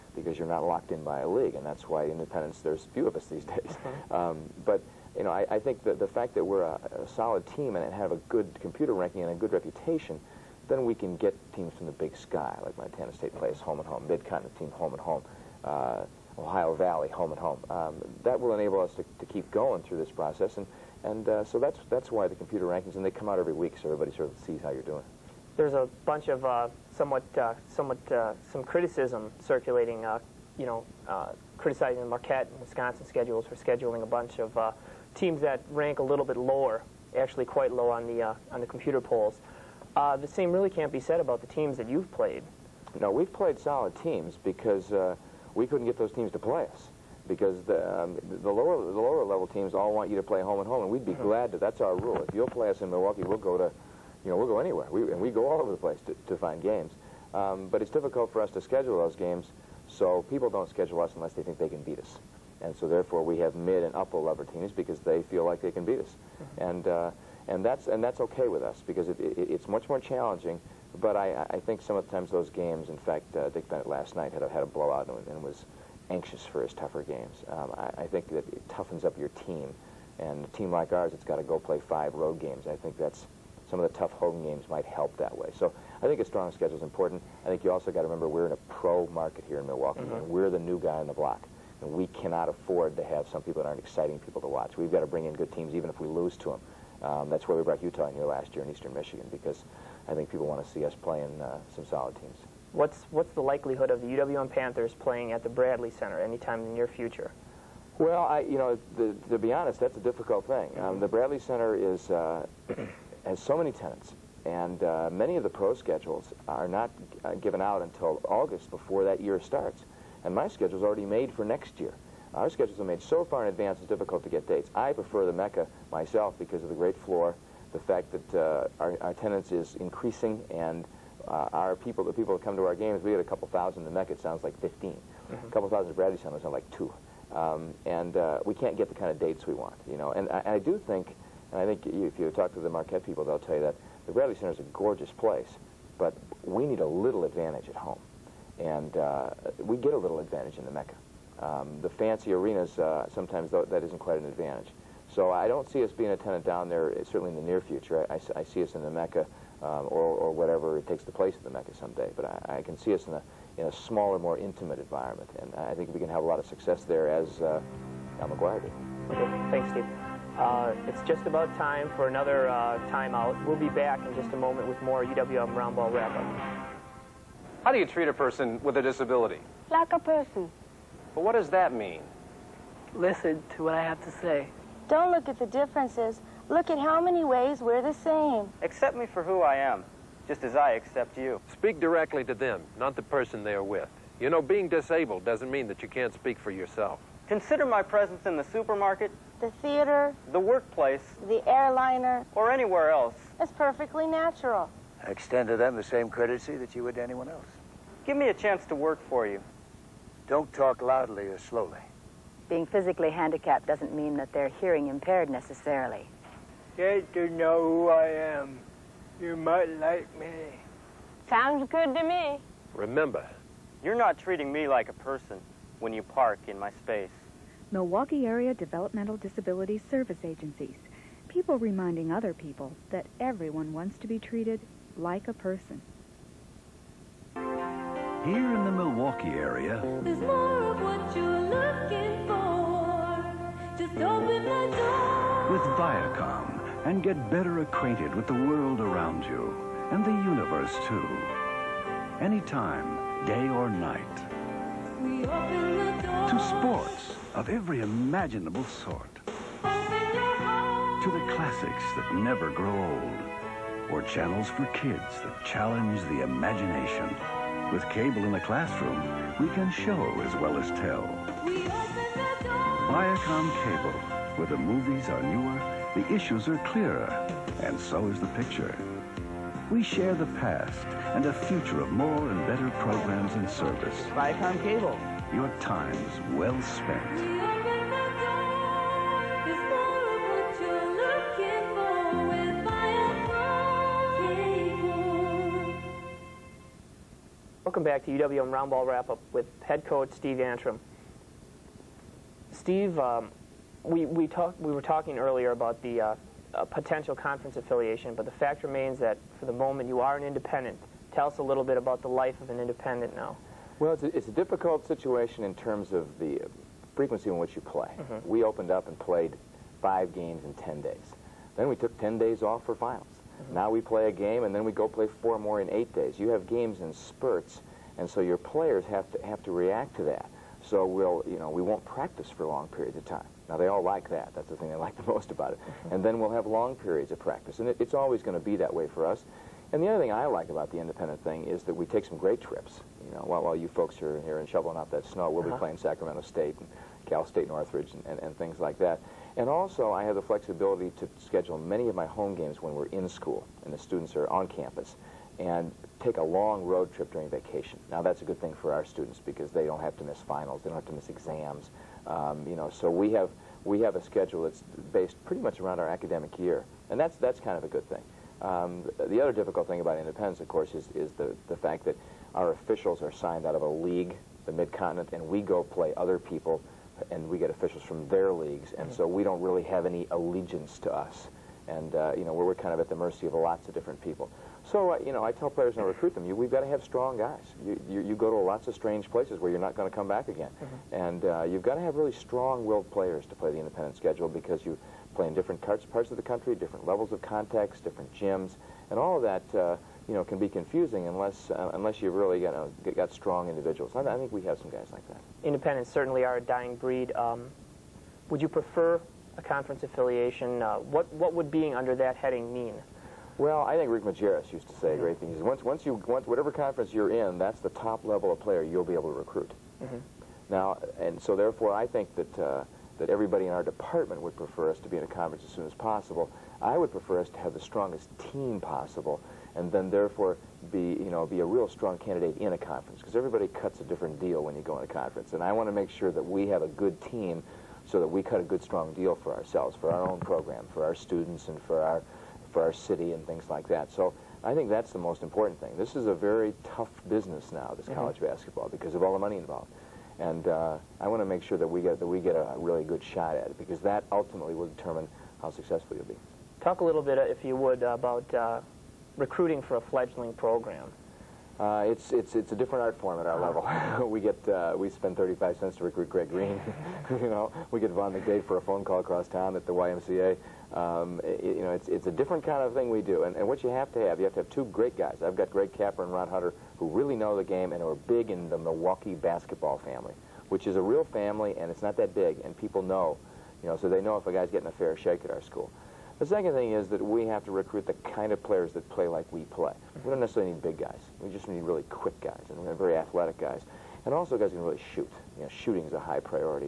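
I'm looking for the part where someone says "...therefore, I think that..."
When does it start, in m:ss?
7:01.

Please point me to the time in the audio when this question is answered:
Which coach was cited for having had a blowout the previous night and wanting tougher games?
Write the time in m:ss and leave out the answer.
1:13.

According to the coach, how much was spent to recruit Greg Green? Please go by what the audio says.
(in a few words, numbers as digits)
35 cents.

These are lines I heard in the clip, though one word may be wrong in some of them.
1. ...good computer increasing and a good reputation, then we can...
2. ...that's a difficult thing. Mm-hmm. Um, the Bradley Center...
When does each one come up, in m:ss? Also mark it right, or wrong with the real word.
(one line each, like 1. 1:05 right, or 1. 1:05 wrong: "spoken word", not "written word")
1. 0:08 wrong: "ranking", not "increasing"
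2. 1:49 right.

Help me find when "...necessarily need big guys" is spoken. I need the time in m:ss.
8:10.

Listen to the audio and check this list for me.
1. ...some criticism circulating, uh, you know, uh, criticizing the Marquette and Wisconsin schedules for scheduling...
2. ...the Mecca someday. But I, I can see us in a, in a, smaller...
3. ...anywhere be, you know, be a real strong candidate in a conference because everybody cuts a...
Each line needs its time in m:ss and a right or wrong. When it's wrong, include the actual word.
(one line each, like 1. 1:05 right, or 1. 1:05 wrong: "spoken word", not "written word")
1. 0:28 right
2. 2:41 right
3. 7:09 wrong: "therefore", not "anywhere".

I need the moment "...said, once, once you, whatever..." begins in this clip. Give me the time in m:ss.
6:55.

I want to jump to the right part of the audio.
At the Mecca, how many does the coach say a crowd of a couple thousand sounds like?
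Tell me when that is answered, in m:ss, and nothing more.
2:14.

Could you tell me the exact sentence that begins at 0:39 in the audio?
the same really can't be said about the teams that you've played.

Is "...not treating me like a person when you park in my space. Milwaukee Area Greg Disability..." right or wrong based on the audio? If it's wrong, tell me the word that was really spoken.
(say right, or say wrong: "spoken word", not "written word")
wrong: "Developmental", not "Greg".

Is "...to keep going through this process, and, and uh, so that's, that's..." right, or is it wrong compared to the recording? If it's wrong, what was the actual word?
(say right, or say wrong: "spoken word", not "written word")
right.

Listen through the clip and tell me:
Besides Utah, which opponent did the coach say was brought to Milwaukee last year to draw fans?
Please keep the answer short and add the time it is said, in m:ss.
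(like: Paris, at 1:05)
Eastern Michigan, at 1:38.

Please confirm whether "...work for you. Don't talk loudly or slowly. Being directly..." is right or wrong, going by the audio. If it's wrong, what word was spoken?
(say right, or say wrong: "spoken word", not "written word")
wrong: "physically", not "directly".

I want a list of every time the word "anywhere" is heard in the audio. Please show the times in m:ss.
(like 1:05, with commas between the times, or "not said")
0:54, 3:22.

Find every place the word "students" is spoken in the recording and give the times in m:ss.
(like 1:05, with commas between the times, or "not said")
5:53, 5:58, 7:20.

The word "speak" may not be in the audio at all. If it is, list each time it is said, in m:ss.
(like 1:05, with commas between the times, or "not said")
3:11, 3:16.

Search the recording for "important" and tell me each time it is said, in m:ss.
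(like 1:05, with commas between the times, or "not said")
1:26, 7:25.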